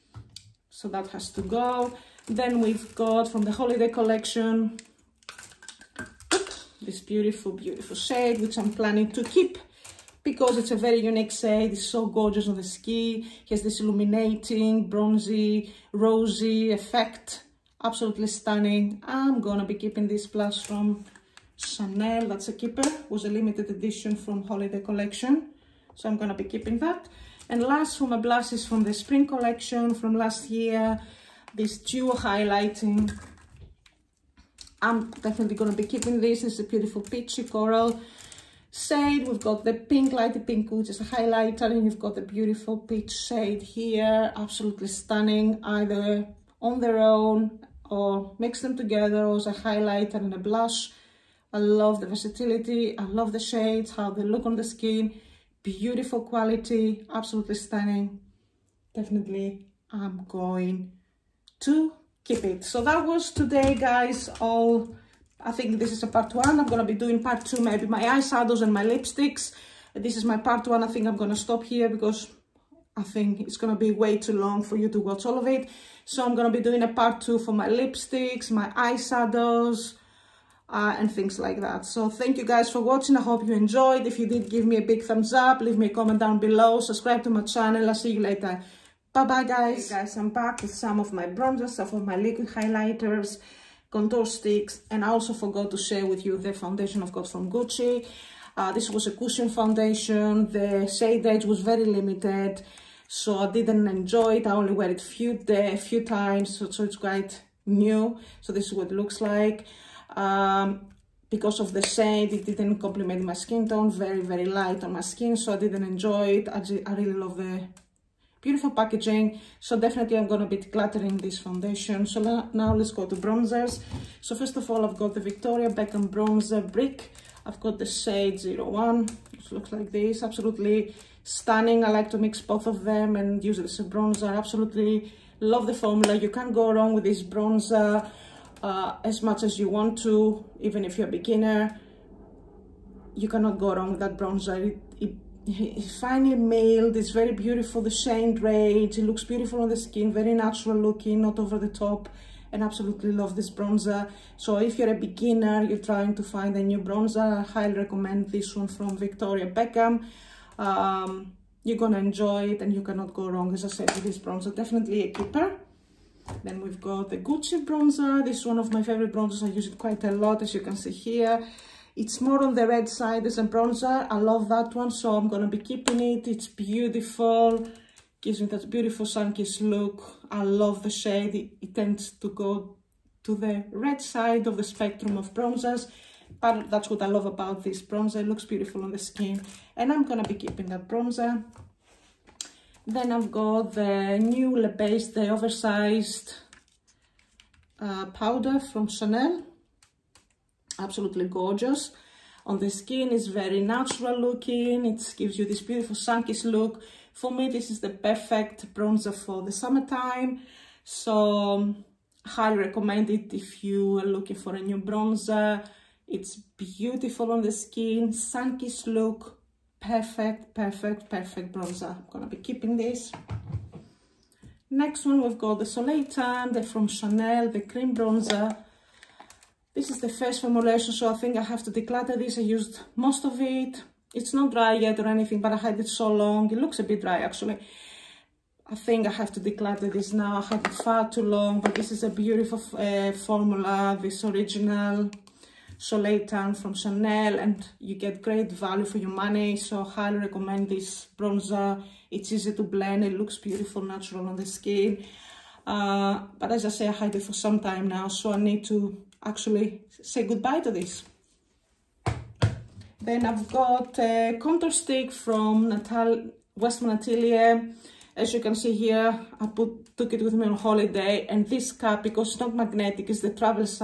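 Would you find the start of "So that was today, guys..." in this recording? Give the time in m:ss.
1:02.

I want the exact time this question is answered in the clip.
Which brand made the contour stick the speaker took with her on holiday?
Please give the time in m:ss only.
4:26.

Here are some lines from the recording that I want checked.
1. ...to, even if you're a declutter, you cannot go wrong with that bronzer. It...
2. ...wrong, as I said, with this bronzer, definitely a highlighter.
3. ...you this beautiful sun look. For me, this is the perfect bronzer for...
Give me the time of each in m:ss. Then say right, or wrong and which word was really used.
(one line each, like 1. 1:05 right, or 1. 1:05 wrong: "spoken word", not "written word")
1. 2:19 wrong: "beginner", not "declutter"
2. 2:43 wrong: "keeper", not "highlighter"
3. 3:25 right.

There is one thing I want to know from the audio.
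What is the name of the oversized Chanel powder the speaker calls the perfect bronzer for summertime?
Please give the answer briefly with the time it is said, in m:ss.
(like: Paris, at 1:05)
Le Beige, at 3:14.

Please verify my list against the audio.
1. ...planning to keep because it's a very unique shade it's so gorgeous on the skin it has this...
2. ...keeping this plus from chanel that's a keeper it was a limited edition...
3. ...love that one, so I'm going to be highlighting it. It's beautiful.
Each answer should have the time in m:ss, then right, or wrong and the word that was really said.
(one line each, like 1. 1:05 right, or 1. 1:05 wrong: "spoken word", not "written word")
1. 0:08 right
2. 0:19 right
3. 2:54 wrong: "keeping", not "highlighting".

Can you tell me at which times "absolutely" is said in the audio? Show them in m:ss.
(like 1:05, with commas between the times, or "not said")
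0:17, 0:44, 0:57, 2:10, 2:14, 2:32, 3:20.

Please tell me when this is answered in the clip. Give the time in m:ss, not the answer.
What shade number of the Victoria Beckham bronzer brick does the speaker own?
2:08.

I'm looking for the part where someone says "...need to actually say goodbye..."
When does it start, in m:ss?
4:18.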